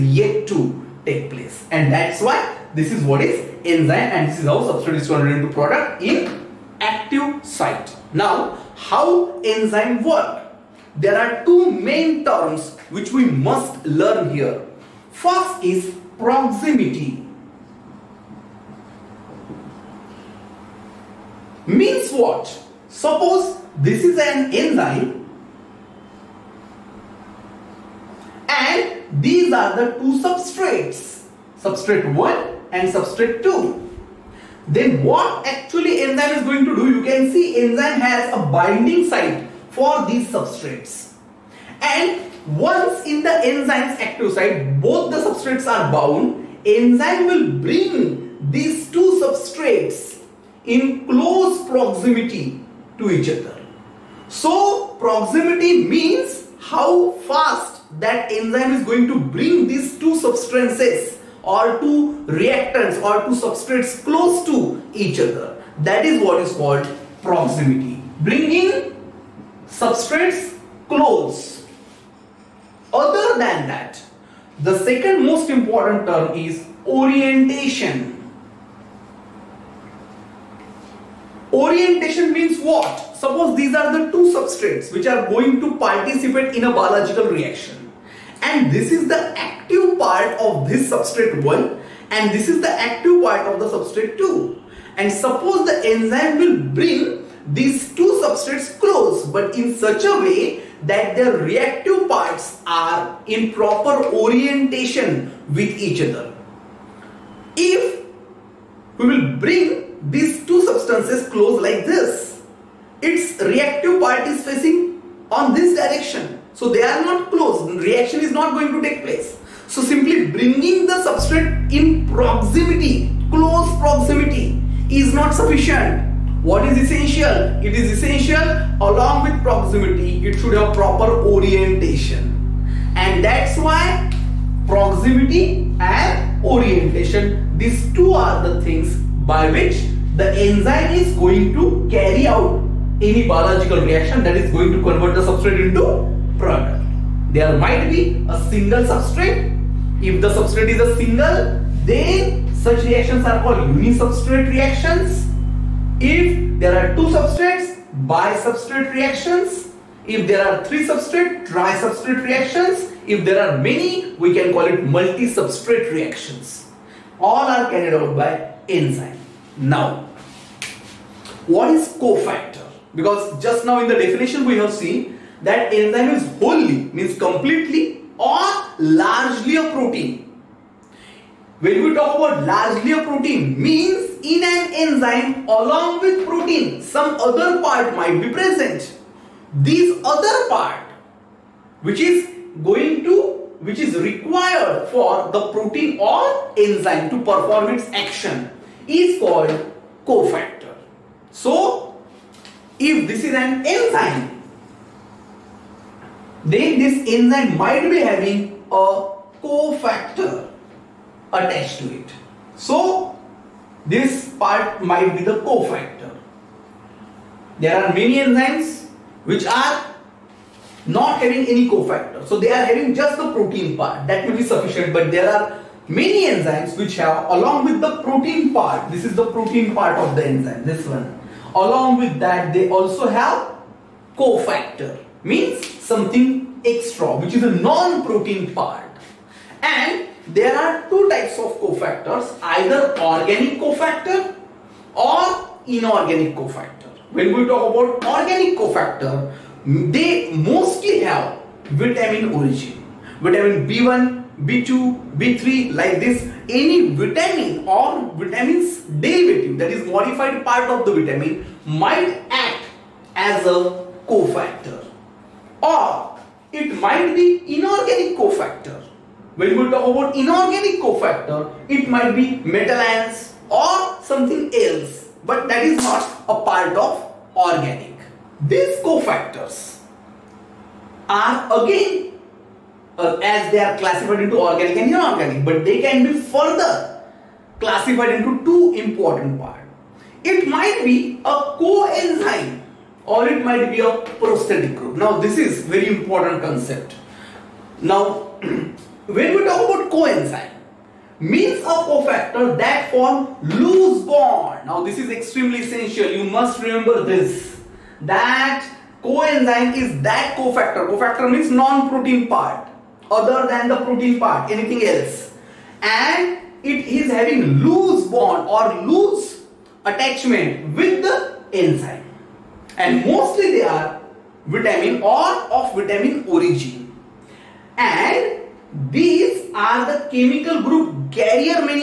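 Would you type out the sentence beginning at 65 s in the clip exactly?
That is what is called proximity.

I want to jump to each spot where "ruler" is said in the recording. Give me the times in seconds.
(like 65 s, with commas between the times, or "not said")
not said.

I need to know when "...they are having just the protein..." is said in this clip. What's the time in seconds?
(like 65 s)
222 s.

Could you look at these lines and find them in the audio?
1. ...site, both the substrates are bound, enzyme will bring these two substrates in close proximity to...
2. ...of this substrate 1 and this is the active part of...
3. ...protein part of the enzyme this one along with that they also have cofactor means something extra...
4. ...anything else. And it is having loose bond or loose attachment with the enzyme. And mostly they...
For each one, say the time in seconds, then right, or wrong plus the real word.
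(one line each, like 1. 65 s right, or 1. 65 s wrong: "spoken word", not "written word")
1. 44 s right
2. 90 s right
3. 229 s right
4. 314 s right.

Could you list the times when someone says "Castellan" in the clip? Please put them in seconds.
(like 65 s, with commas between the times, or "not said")
not said.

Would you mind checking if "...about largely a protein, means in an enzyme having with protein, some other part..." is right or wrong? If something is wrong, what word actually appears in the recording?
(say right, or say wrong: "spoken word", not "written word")
wrong: "along", not "having".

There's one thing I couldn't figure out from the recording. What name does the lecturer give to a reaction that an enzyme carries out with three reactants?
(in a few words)
Tri-substrate reactions.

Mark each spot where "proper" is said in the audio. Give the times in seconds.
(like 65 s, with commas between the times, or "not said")
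103 s, 130 s.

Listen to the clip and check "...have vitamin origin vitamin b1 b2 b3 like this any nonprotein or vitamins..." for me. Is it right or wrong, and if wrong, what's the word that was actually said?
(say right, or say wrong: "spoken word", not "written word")
wrong: "vitamin", not "nonprotein".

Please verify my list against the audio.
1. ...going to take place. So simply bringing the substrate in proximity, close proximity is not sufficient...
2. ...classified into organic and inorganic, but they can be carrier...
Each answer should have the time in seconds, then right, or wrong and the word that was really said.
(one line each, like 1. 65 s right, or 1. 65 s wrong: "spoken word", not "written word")
1. 118 s right
2. 283 s wrong: "further", not "carrier".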